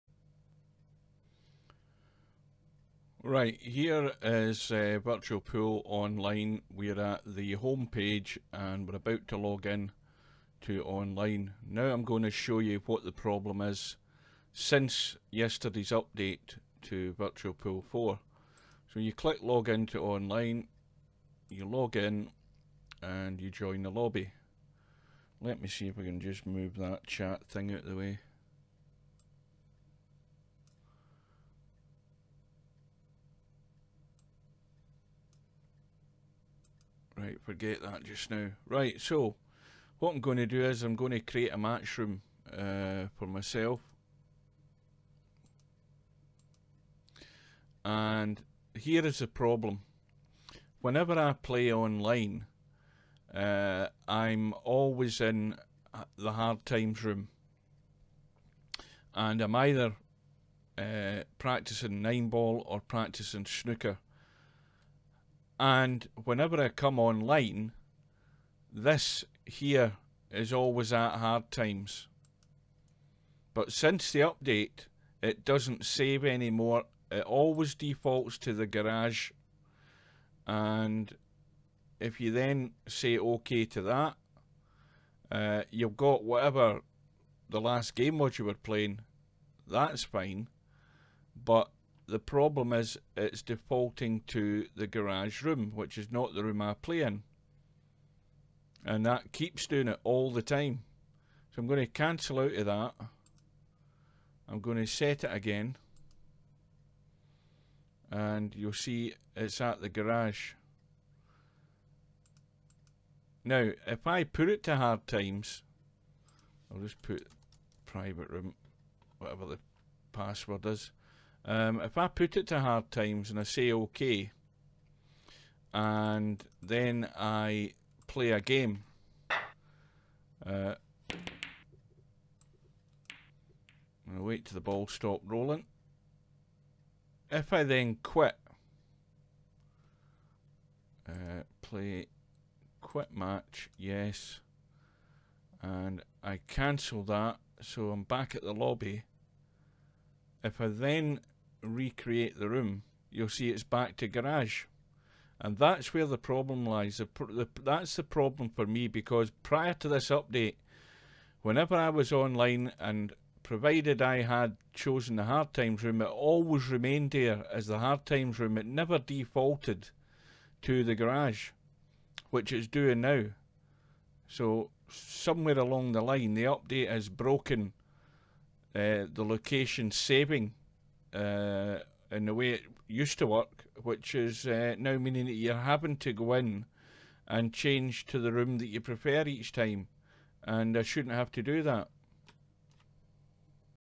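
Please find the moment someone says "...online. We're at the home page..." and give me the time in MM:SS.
00:05.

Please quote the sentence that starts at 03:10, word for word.
And I shouldn't have to do that.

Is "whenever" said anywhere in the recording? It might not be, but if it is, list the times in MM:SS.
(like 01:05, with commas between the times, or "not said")
00:50, 01:06, 02:41.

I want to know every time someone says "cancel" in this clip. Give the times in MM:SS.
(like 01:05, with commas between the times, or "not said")
01:41, 02:26.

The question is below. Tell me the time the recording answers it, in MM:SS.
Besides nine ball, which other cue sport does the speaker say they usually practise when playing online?
01:03.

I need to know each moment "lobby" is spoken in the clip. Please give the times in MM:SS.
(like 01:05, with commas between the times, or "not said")
00:23, 02:28.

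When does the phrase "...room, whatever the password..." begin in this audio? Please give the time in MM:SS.
01:58.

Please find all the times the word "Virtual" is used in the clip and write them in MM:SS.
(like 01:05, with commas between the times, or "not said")
00:05, 00:17.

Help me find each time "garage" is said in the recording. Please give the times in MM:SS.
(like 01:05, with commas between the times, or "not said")
01:18, 01:34, 01:49, 02:34, 02:50.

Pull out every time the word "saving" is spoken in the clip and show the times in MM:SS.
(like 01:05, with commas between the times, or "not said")
02:59.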